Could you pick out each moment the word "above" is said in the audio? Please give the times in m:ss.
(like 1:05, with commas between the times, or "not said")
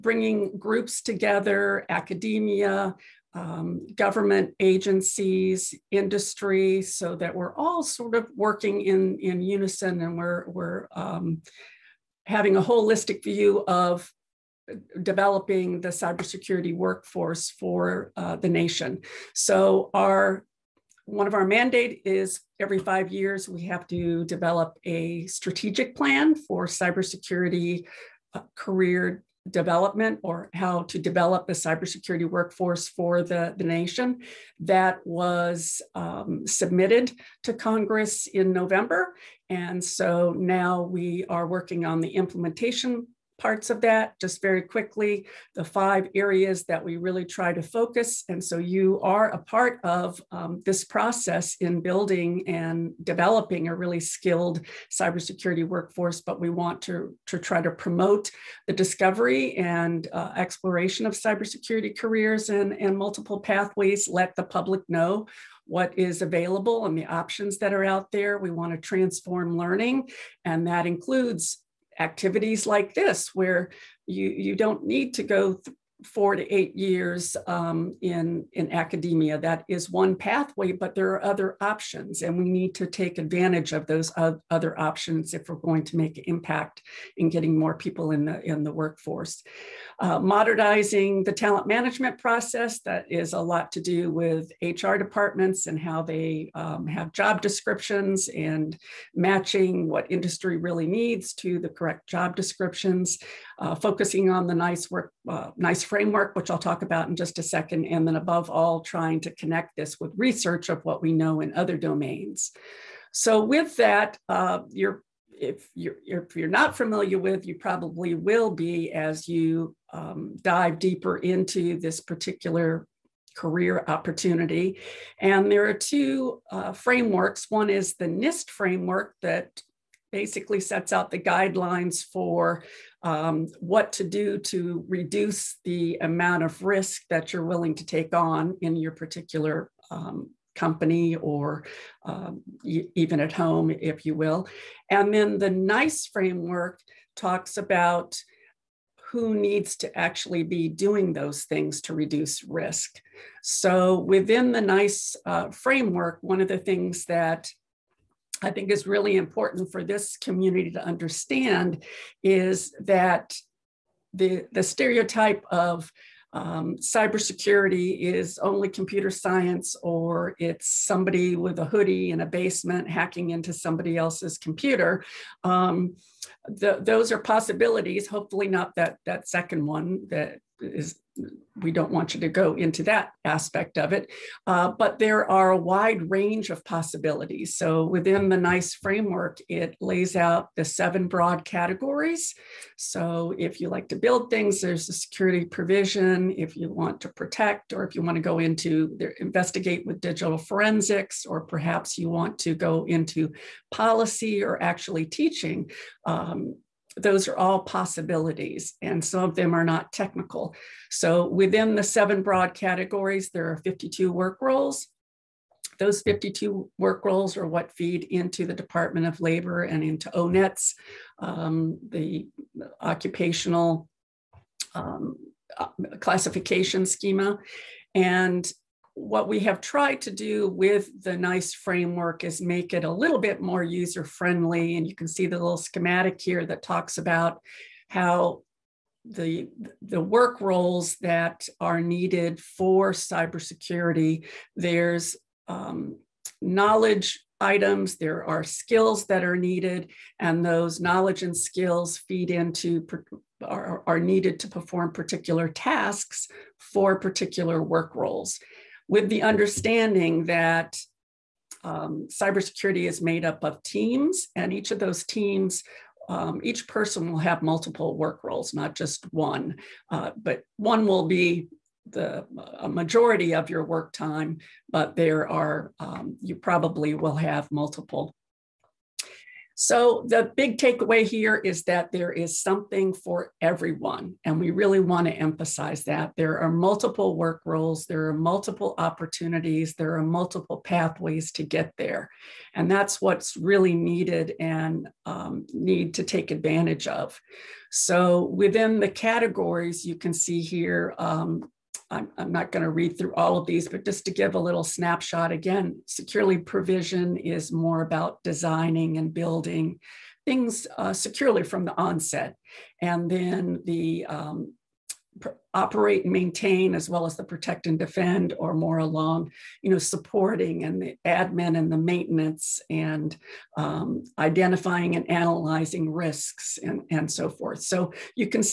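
1:48.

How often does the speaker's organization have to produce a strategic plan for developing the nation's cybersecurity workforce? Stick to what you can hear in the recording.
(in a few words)
every 5 years.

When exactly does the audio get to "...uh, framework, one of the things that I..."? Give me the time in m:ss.
2:35.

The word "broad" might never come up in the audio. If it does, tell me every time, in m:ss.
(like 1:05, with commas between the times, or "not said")
3:11, 3:32.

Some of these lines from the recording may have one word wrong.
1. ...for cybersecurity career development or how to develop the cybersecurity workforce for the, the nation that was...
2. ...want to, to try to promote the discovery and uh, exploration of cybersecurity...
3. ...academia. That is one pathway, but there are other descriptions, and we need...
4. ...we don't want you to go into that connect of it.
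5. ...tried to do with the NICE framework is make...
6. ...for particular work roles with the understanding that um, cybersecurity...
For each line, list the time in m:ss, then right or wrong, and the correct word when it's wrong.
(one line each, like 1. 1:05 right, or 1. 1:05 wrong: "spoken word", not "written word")
1. 0:26 right
2. 0:56 right
3. 1:18 wrong: "options", not "descriptions"
4. 3:01 wrong: "aspect", not "connect"
5. 3:49 right
6. 4:16 right.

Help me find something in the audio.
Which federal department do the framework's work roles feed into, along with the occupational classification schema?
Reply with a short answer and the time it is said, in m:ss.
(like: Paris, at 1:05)
Department of Labor, at 3:38.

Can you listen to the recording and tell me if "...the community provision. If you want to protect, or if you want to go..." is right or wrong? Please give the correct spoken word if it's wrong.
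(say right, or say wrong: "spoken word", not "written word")
wrong: "security", not "community".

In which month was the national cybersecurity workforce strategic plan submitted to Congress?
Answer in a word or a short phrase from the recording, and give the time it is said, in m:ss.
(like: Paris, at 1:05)
November, at 0:38.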